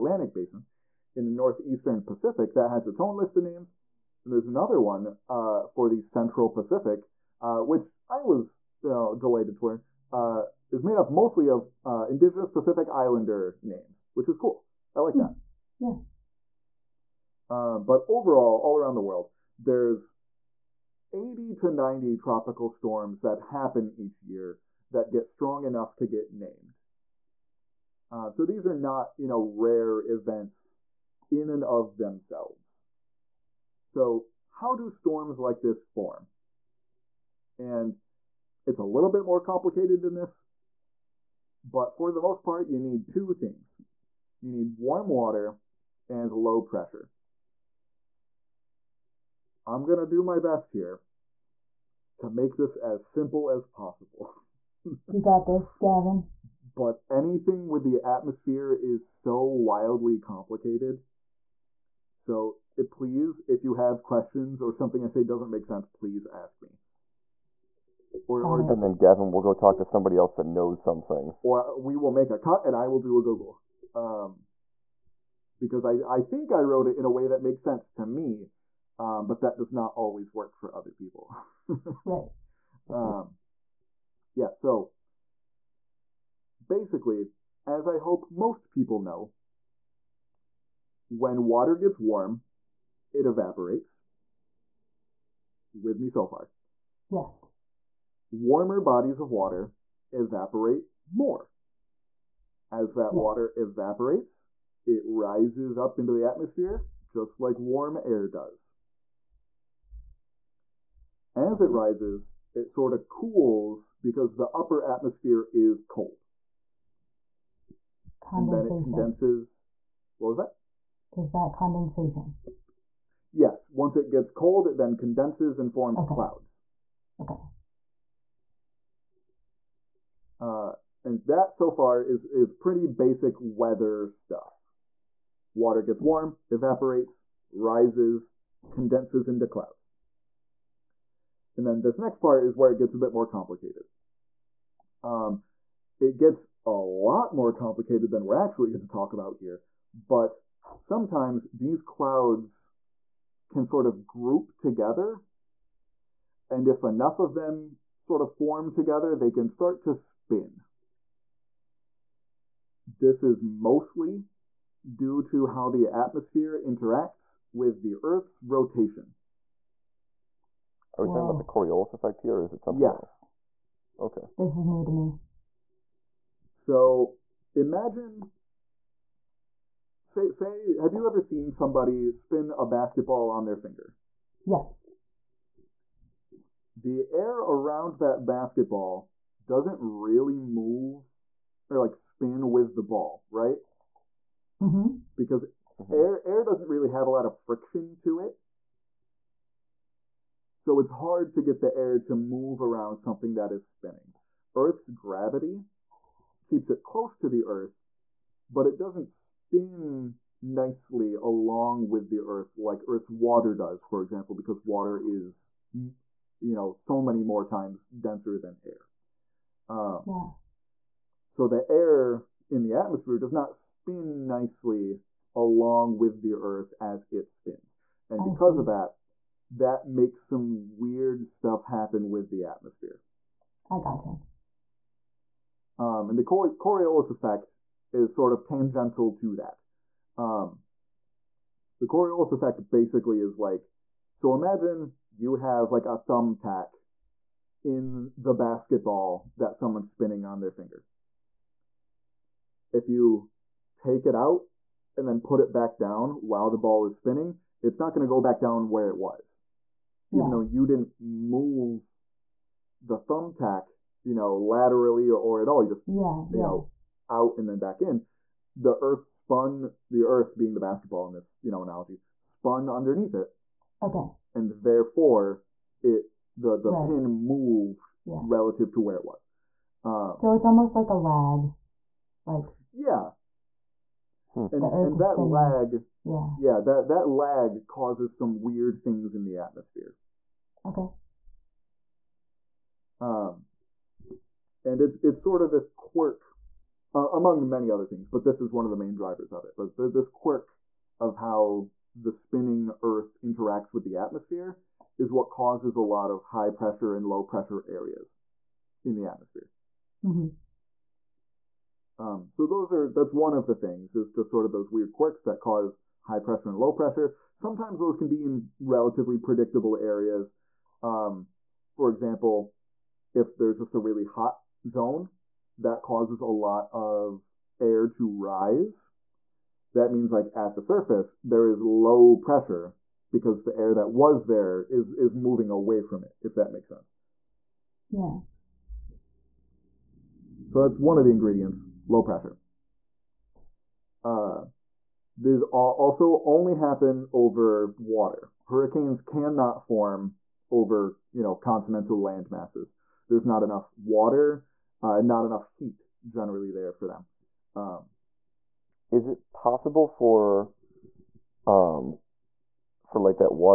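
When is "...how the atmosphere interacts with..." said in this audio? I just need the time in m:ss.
2:45.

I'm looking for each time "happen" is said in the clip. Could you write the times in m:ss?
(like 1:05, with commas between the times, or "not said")
0:23, 3:51, 5:46.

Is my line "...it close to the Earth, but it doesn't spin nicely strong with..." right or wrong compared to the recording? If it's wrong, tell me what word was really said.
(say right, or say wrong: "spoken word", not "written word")
wrong: "along", not "strong".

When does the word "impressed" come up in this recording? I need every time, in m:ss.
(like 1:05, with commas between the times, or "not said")
not said.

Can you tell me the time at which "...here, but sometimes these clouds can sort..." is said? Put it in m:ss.
2:29.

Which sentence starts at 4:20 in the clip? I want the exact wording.
Even though you didn't move the thumbtack, you know, laterally or, or at all, you just, yeah, you yeah.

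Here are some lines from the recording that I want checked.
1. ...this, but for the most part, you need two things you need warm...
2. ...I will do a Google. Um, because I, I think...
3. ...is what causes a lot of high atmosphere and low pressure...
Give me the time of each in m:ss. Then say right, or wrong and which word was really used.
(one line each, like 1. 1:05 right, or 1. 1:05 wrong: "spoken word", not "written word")
1. 0:40 right
2. 1:12 right
3. 5:04 wrong: "pressure", not "atmosphere".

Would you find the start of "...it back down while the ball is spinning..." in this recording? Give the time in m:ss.
4:15.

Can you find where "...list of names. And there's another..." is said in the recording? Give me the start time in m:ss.
0:03.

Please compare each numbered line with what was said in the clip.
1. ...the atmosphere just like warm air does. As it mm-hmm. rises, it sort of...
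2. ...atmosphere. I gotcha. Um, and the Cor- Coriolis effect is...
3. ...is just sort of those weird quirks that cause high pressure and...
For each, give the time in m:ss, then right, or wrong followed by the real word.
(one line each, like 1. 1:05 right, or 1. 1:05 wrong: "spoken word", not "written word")
1. 1:46 right
2. 3:52 right
3. 5:13 right.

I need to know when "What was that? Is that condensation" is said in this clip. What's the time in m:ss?
2:00.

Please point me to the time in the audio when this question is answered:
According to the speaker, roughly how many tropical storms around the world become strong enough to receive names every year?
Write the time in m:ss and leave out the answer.
0:21.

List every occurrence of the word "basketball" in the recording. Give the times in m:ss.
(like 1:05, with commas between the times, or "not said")
3:02, 3:08, 4:08, 4:30.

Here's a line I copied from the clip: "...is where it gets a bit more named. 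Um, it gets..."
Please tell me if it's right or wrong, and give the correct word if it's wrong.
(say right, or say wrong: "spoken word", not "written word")
wrong: "complicated", not "named".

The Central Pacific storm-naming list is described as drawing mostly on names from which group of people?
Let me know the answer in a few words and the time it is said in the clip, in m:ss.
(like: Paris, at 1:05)
indigenous Pacific Islander, at 0:12.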